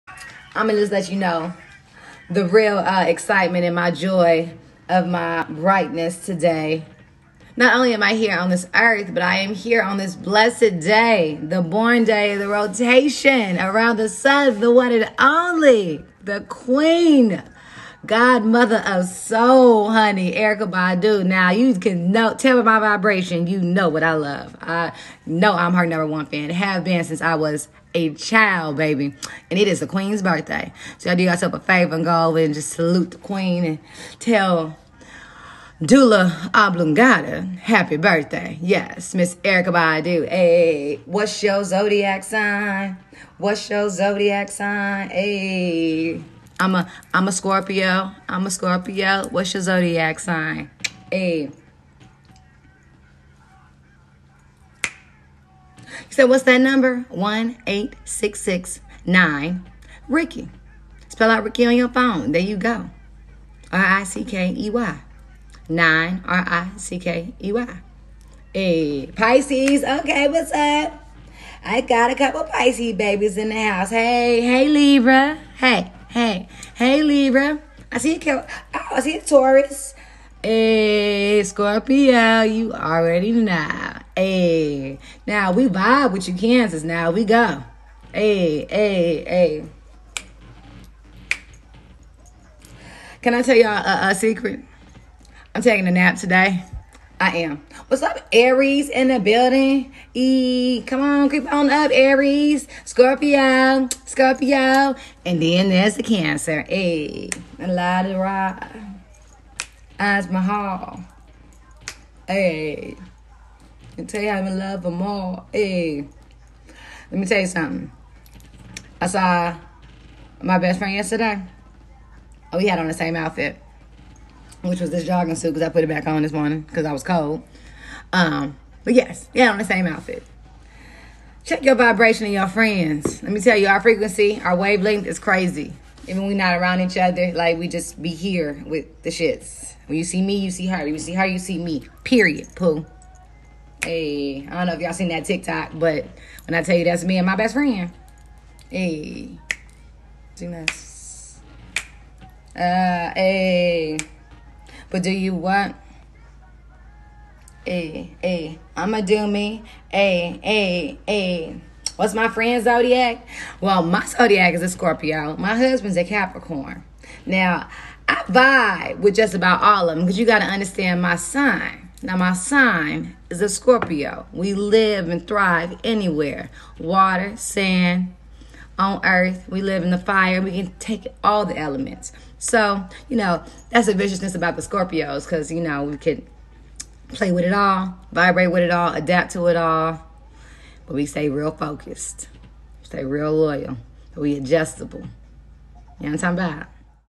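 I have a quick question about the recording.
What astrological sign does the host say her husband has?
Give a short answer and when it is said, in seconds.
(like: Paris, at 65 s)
Capricorn, at 166 s.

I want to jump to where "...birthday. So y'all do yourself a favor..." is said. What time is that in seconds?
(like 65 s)
30 s.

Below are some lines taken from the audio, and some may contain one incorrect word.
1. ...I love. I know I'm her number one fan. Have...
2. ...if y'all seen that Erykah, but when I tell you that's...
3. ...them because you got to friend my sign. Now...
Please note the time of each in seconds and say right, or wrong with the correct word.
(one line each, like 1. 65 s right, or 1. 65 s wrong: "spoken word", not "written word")
1. 24 s right
2. 144 s wrong: "TikTok", not "Erykah"
3. 169 s wrong: "understand", not "friend".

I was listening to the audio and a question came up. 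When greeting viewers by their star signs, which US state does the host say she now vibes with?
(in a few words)
Kansas.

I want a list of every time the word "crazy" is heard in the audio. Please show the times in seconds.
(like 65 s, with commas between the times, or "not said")
135 s.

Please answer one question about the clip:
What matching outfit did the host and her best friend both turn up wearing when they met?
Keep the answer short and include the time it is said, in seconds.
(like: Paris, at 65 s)
Jogging suit, at 125 s.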